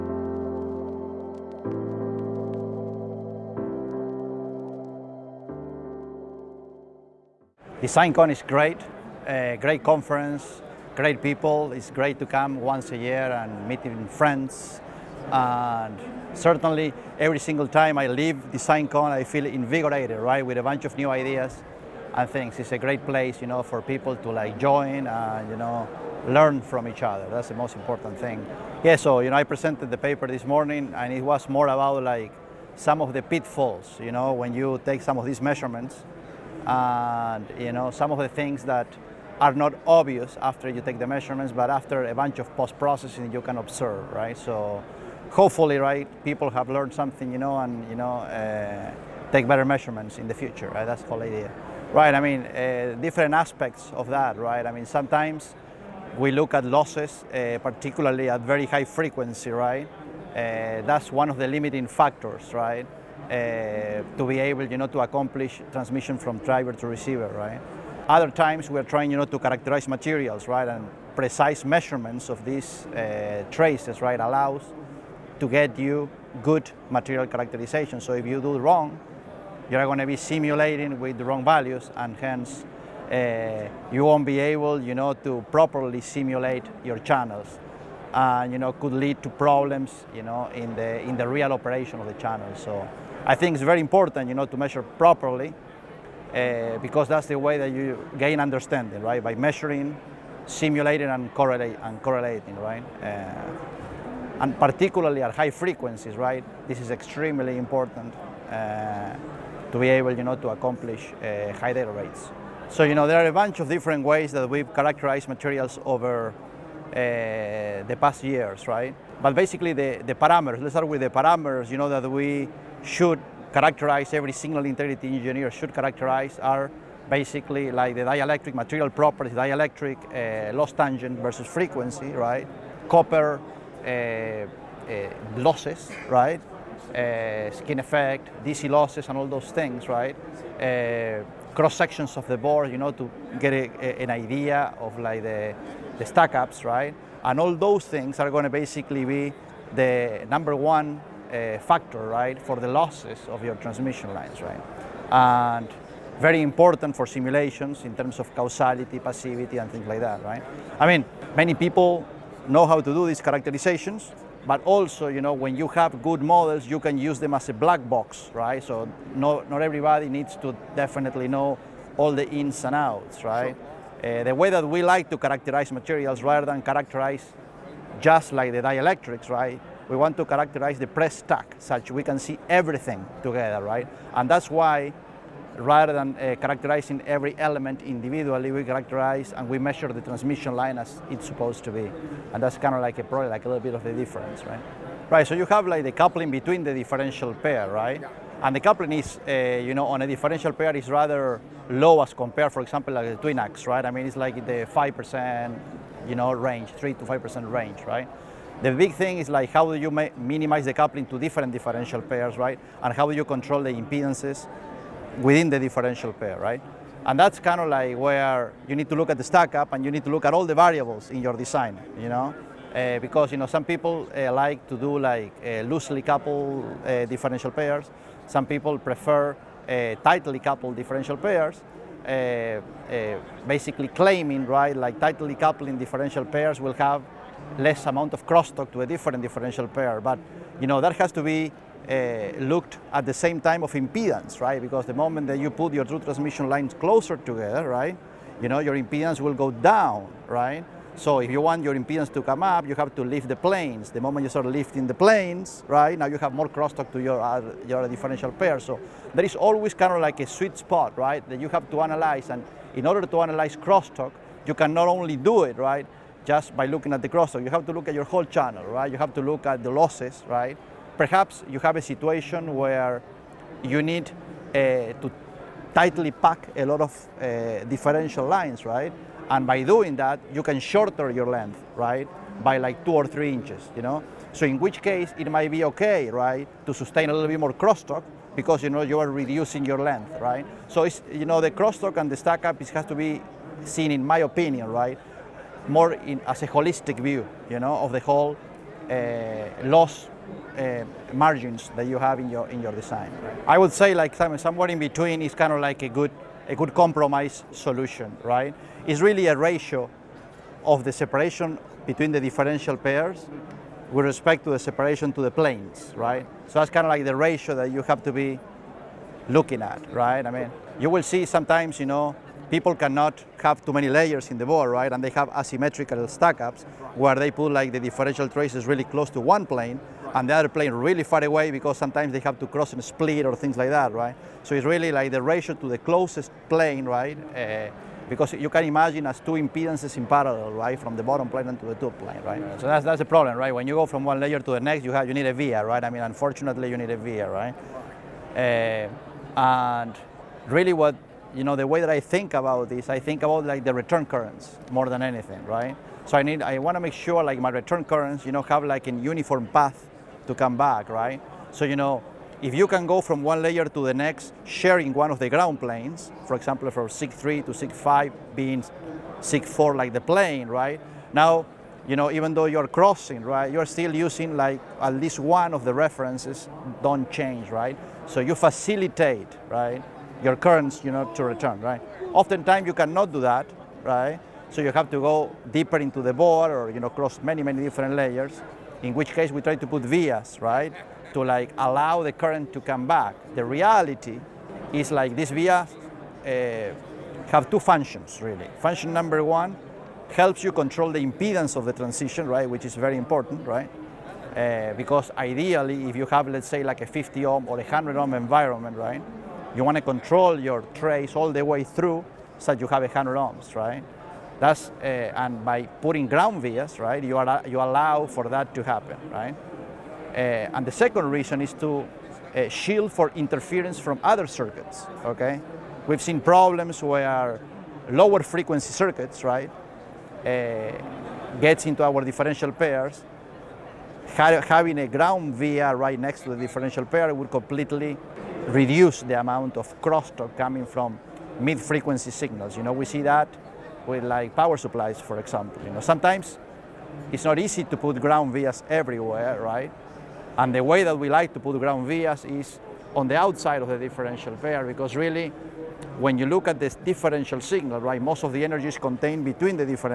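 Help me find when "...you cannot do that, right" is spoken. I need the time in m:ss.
6:22.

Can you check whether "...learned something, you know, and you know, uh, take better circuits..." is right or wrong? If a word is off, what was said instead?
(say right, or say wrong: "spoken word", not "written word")
wrong: "measurements", not "circuits".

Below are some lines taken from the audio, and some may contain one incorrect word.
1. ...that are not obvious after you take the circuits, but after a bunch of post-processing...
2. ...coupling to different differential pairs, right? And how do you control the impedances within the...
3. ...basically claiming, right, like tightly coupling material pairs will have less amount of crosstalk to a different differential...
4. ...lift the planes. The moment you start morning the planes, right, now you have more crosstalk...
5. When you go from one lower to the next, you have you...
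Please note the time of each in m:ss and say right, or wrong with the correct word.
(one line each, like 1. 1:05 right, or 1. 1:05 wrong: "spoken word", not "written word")
1. 0:38 wrong: "measurements", not "circuits"
2. 3:30 right
3. 3:53 wrong: "differential", not "material"
4. 4:13 wrong: "lifting", not "morning"
5. 5:43 wrong: "layer", not "lower".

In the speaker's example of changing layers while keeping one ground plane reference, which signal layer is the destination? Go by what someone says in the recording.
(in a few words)
SIG5.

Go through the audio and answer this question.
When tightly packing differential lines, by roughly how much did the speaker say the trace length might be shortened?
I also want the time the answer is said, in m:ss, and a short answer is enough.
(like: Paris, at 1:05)
two or three inches, at 4:42.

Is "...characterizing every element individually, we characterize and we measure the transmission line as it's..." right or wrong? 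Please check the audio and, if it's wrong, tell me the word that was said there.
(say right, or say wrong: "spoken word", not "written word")
right.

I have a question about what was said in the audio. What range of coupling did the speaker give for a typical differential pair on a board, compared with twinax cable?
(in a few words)
3 to 5%.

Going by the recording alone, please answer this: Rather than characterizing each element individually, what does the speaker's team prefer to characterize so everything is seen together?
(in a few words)
the press stack.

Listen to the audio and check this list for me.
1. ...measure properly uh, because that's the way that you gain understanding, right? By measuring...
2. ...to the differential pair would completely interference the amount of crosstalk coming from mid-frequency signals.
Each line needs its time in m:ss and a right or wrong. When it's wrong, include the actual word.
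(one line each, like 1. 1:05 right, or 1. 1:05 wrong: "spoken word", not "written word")
1. 1:34 right
2. 7:16 wrong: "reduce", not "interference".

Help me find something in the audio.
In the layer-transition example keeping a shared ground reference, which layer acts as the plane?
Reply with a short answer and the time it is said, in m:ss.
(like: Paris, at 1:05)
SIG4, at 6:09.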